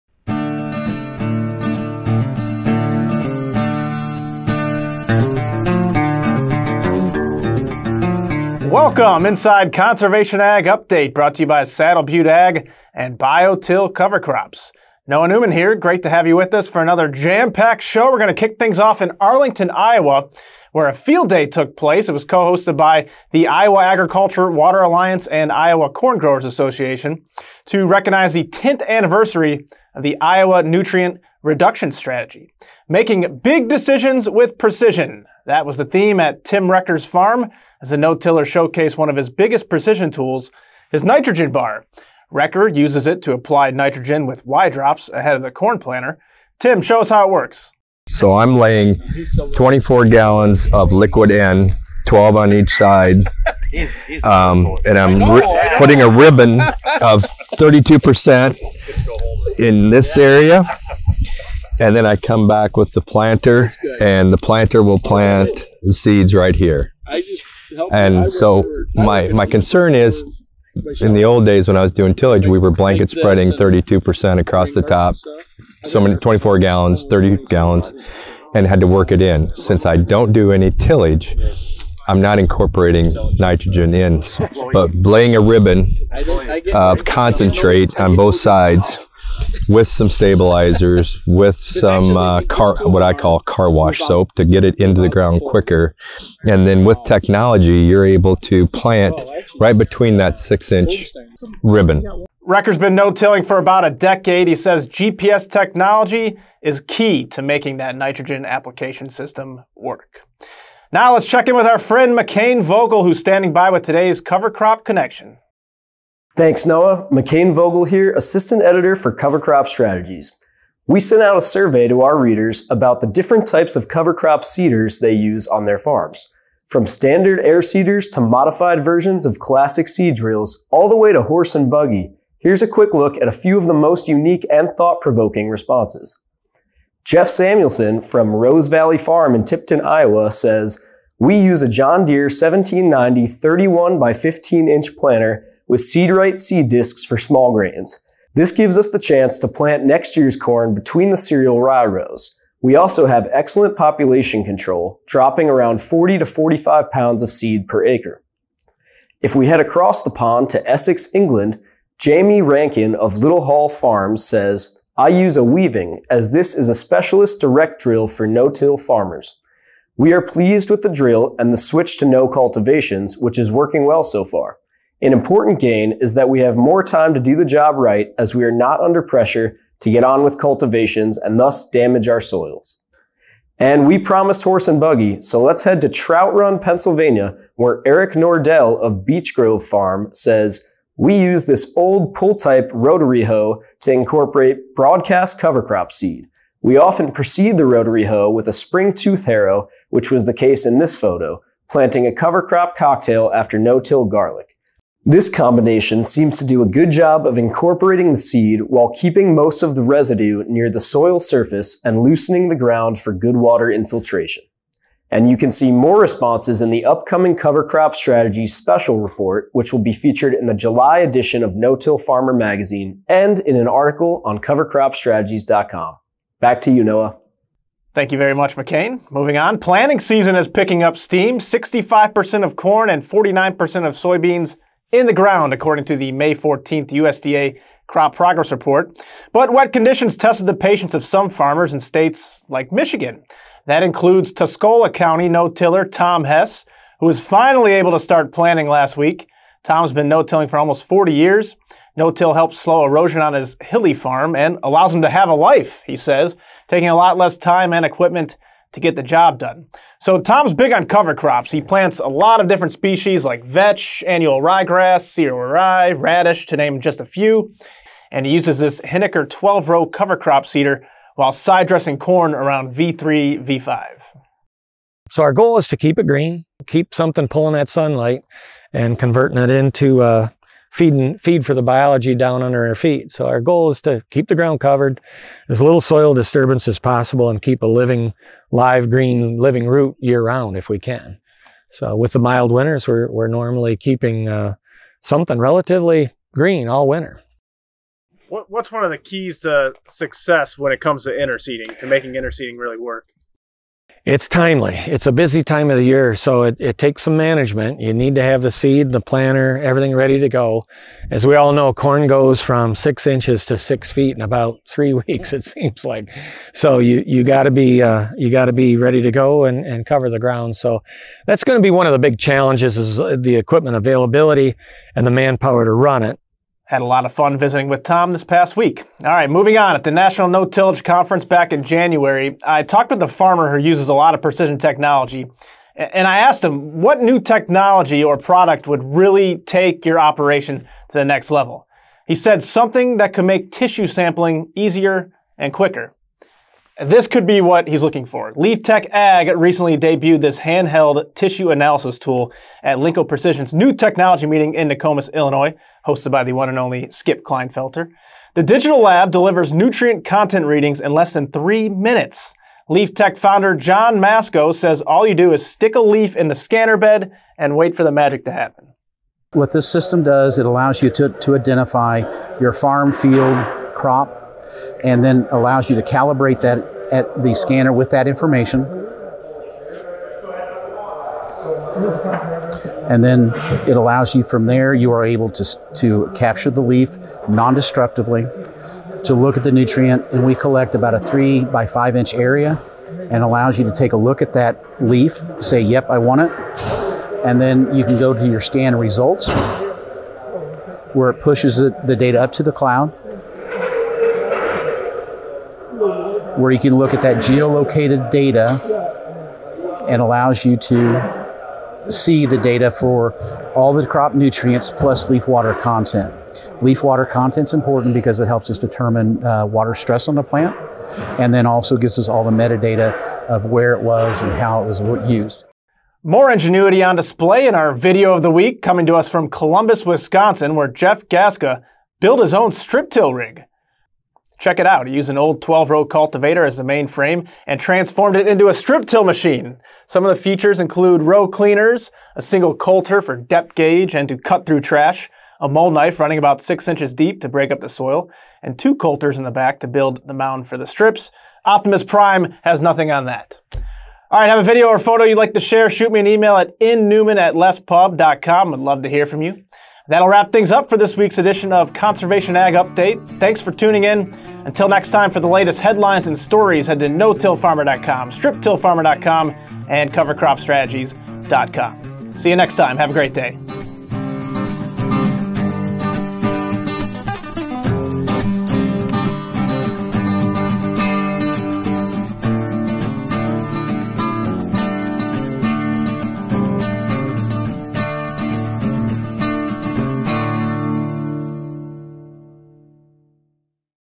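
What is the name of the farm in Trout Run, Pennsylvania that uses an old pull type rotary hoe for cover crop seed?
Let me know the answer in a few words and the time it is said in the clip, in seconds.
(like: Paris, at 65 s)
Beech Grove Farm, at 189 s.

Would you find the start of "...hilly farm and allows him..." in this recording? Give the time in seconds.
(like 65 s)
253 s.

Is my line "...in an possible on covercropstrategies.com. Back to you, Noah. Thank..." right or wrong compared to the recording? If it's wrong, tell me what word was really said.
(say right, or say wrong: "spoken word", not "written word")
wrong: "article", not "possible".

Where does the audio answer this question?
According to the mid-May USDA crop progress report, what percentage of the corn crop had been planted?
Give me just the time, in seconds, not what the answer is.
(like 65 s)
231 s.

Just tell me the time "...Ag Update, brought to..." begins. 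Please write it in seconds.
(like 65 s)
10 s.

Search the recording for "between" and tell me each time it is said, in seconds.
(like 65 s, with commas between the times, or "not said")
99 s, 150 s.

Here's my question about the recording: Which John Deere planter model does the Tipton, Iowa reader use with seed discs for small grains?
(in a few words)
1790.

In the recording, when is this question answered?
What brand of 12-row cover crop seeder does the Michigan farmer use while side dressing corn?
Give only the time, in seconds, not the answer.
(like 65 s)
268 s.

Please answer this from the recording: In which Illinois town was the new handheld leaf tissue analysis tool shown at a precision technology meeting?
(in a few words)
Nokomis.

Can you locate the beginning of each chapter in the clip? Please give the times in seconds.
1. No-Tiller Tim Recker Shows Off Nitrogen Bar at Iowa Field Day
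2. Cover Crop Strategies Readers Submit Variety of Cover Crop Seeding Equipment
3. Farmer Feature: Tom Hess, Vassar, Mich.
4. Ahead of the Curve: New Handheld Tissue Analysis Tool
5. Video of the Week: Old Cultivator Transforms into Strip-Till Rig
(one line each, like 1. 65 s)
1. 20 s
2. 115 s
3. 230 s
4. 329 s
5. 427 s.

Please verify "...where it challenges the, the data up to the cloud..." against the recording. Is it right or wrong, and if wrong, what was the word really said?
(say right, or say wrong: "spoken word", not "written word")
wrong: "pushes", not "challenges".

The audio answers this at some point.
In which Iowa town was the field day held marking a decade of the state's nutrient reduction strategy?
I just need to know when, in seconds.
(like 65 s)
19 s.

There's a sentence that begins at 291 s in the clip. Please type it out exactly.
So with the mild winters, we're we're normally keeping uh, something relatively green all winter.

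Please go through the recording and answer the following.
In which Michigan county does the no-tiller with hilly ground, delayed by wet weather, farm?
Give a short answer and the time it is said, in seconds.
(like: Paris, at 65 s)
Tuscola County, at 244 s.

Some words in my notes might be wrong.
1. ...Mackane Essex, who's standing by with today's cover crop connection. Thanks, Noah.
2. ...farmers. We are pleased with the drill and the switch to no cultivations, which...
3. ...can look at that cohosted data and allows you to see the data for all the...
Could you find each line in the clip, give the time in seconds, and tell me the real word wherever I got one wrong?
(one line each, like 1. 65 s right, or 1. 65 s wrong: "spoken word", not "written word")
1. 112 s wrong: "Vogel", not "Essex"
2. 168 s right
3. 406 s wrong: "geolocated", not "cohosted".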